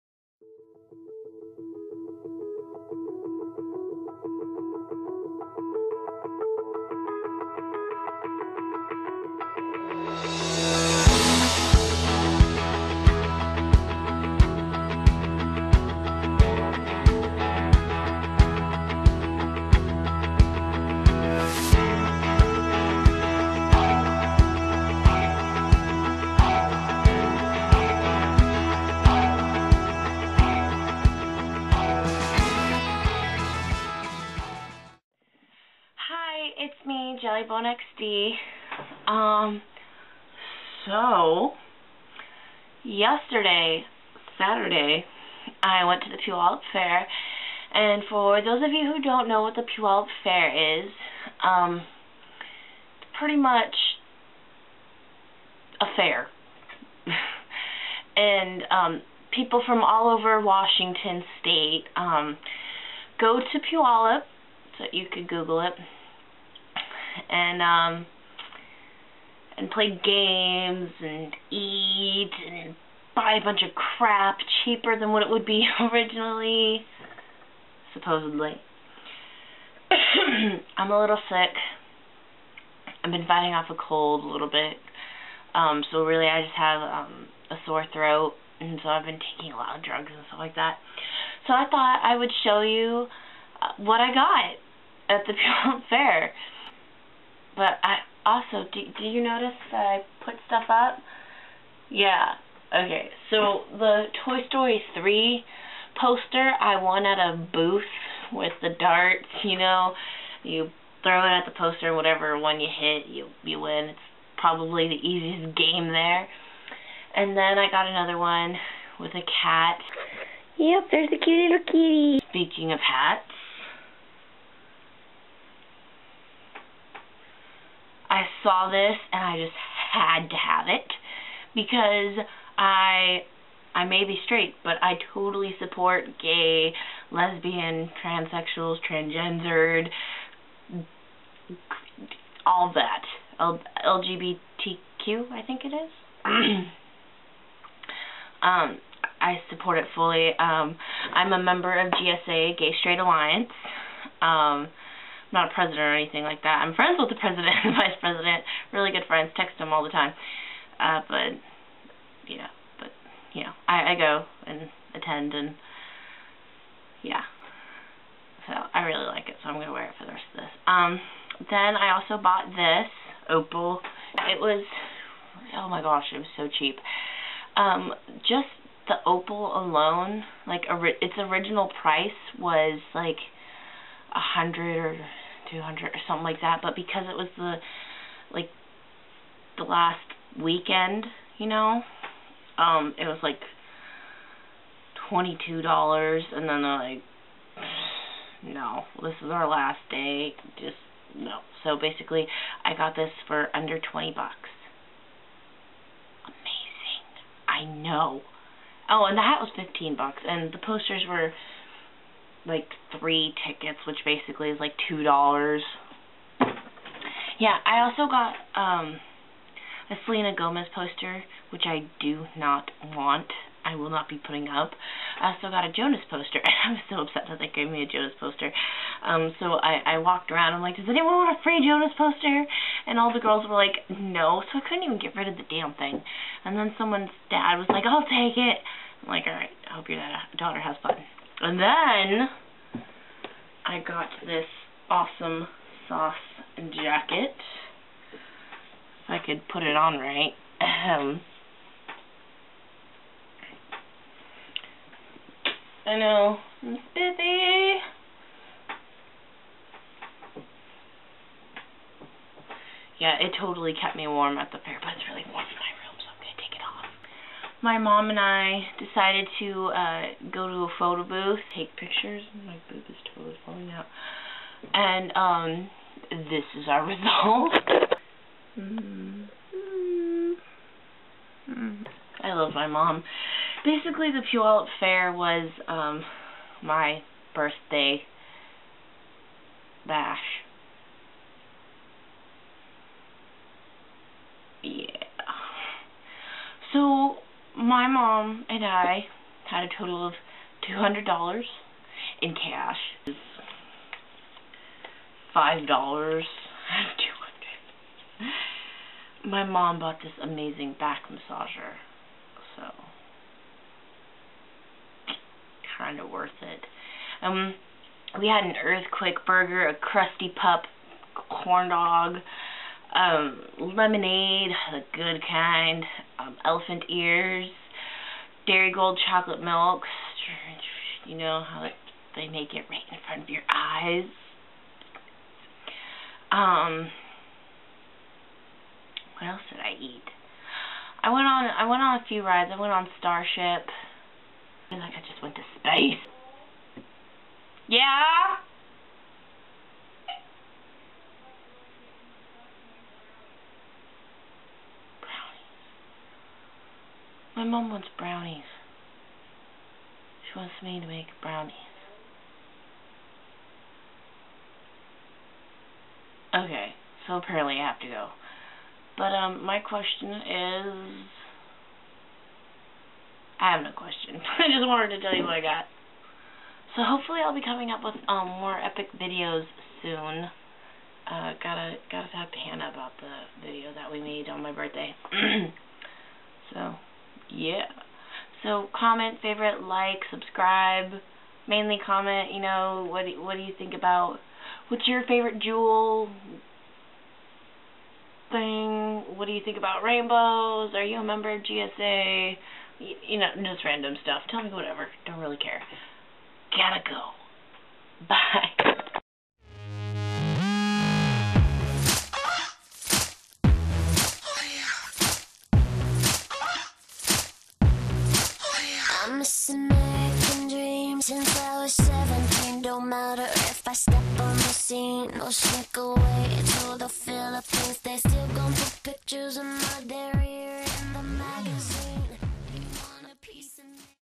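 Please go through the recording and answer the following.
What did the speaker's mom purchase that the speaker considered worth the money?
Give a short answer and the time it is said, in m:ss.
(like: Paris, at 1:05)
Back massager, at 5:10.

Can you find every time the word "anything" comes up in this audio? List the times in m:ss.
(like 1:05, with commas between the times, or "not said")
2:35.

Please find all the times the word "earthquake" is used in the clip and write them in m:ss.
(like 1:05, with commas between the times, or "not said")
5:18.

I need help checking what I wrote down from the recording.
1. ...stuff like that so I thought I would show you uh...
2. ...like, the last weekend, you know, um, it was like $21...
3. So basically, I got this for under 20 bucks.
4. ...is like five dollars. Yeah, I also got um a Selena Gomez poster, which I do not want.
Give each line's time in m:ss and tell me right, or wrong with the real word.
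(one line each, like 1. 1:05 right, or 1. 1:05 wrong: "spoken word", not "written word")
1. 1:30 right
2. 3:08 wrong: "22", not "21"
3. 3:21 right
4. 3:34 wrong: "two", not "five".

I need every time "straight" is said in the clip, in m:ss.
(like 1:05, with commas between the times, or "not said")
2:14, 2:32.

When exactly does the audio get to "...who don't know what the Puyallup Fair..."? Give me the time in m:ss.
0:48.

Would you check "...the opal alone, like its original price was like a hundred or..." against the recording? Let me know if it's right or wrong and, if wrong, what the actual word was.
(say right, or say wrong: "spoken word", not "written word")
right.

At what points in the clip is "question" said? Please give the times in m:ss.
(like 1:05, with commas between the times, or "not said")
6:09, 6:13.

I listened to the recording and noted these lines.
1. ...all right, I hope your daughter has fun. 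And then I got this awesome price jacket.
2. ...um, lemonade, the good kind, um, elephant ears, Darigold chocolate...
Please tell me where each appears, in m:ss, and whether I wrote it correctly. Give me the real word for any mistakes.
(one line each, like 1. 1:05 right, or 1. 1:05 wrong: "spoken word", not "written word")
1. 3:59 wrong: "sauce", not "price"
2. 5:22 right.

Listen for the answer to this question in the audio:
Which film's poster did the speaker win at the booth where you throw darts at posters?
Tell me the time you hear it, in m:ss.
1:44.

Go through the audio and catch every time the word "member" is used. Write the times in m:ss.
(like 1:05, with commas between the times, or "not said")
2:31, 6:41.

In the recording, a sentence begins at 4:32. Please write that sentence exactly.
My boob is totally falling out.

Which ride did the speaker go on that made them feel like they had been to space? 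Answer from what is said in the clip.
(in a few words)
Starship.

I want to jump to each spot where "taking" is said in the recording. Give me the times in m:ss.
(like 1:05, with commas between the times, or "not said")
1:29.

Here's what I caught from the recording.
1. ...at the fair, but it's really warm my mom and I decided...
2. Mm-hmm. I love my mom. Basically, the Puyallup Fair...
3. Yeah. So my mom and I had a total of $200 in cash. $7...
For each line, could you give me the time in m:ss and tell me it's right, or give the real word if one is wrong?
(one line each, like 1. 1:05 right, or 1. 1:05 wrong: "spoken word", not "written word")
1. 4:24 right
2. 4:38 right
3. 4:54 wrong: "5", not "7".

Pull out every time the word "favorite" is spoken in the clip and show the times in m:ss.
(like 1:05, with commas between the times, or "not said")
6:29, 6:35.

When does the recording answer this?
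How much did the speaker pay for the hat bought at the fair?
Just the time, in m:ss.
3:29.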